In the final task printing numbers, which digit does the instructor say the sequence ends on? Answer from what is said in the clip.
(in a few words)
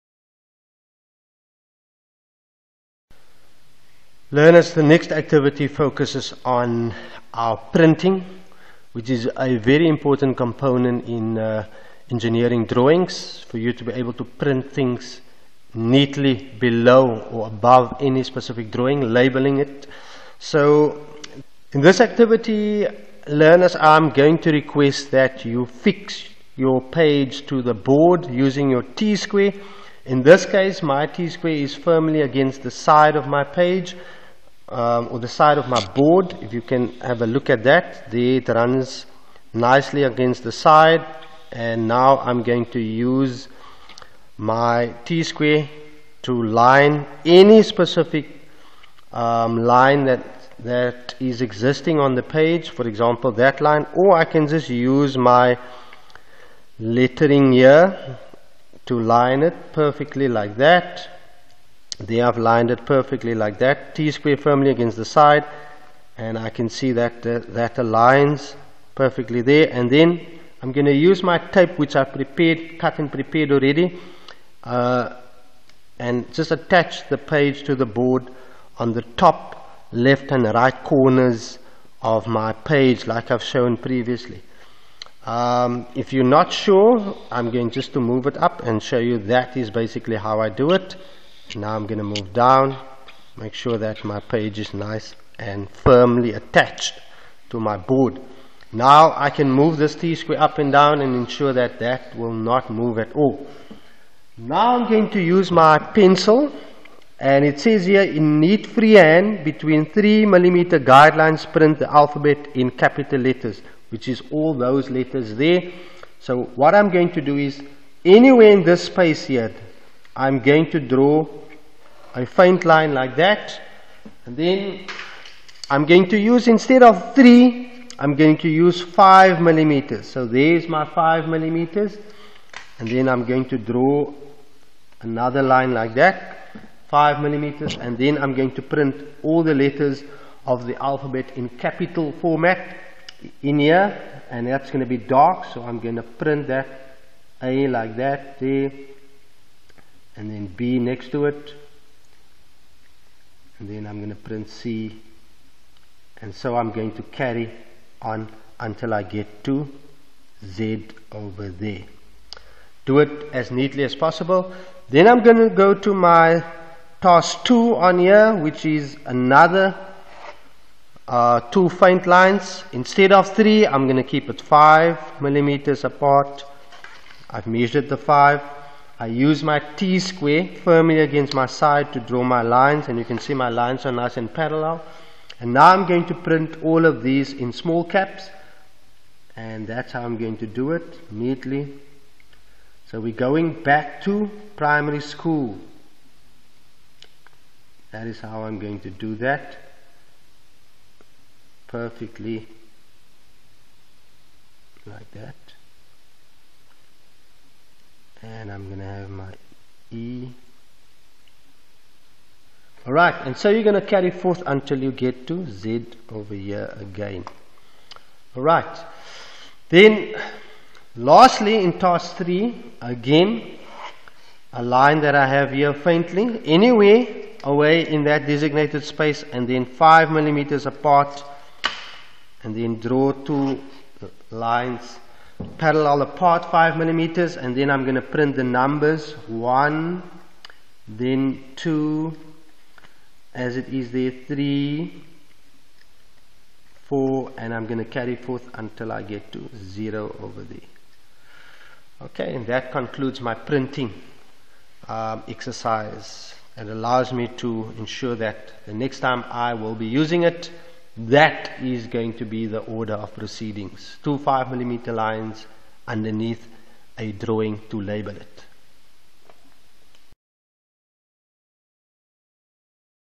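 0.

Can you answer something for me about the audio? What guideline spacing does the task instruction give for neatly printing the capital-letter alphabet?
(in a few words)
3 millimeters.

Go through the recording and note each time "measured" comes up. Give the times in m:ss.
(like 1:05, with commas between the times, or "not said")
2:57.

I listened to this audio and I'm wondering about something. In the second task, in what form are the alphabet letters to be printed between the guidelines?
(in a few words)
Small caps.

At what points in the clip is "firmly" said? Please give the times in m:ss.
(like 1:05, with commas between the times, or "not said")
0:31, 1:04, 1:35, 3:00.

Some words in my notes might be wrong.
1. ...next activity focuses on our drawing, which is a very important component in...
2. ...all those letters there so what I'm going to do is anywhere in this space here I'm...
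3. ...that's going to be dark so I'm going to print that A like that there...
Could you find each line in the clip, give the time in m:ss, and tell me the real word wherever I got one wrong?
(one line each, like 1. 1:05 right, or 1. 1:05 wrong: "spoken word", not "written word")
1. 0:04 wrong: "printing", not "drawing"
2. 1:54 right
3. 2:24 right.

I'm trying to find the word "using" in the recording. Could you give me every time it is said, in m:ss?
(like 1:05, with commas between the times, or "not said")
0:28, 4:19.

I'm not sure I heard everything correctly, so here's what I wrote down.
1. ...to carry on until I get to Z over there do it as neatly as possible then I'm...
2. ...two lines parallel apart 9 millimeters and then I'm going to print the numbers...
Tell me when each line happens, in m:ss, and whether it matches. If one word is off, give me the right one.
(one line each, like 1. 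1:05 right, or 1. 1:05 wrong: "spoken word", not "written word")
1. 2:36 right
2. 3:53 wrong: "5", not "9".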